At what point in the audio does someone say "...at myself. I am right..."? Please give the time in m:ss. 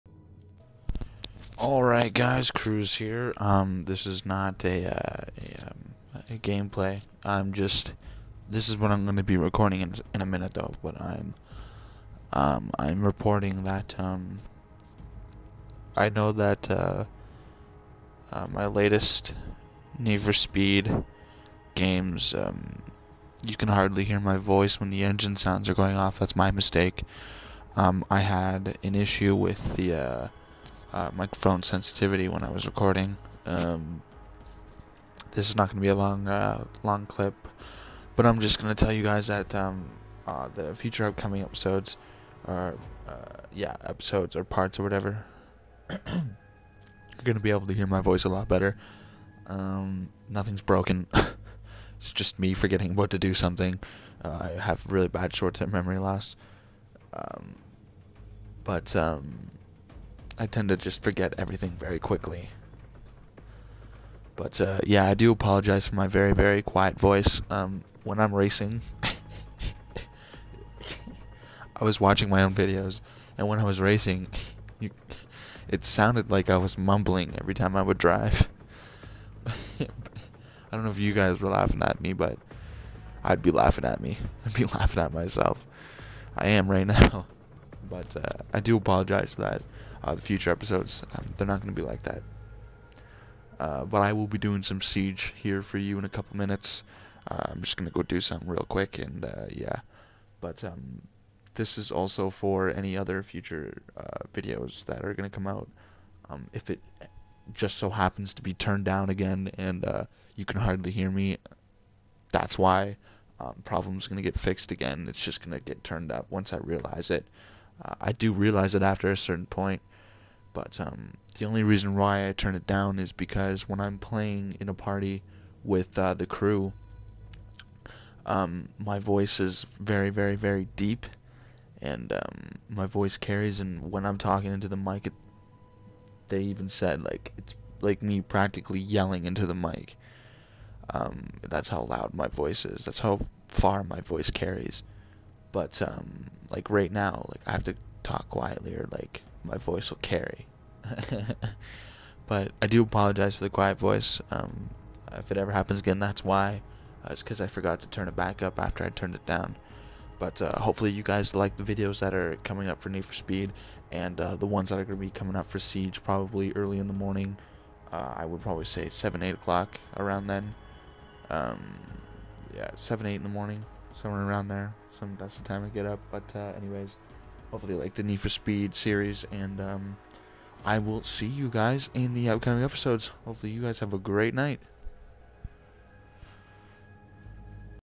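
1:25.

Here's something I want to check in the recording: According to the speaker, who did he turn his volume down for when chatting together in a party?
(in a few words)
the crew.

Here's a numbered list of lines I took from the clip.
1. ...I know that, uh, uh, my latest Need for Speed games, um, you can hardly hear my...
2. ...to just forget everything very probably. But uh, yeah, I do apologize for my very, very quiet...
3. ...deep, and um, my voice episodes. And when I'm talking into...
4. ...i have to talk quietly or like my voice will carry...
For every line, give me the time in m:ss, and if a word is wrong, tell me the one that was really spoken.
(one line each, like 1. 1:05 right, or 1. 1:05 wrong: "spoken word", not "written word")
1. 0:15 right
2. 1:00 wrong: "quickly", not "probably"
3. 2:10 wrong: "carries", not "episodes"
4. 2:27 right.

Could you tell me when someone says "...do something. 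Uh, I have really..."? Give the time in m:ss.
0:53.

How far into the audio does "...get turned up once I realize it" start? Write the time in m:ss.
1:55.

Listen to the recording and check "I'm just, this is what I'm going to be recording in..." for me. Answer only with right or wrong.
right.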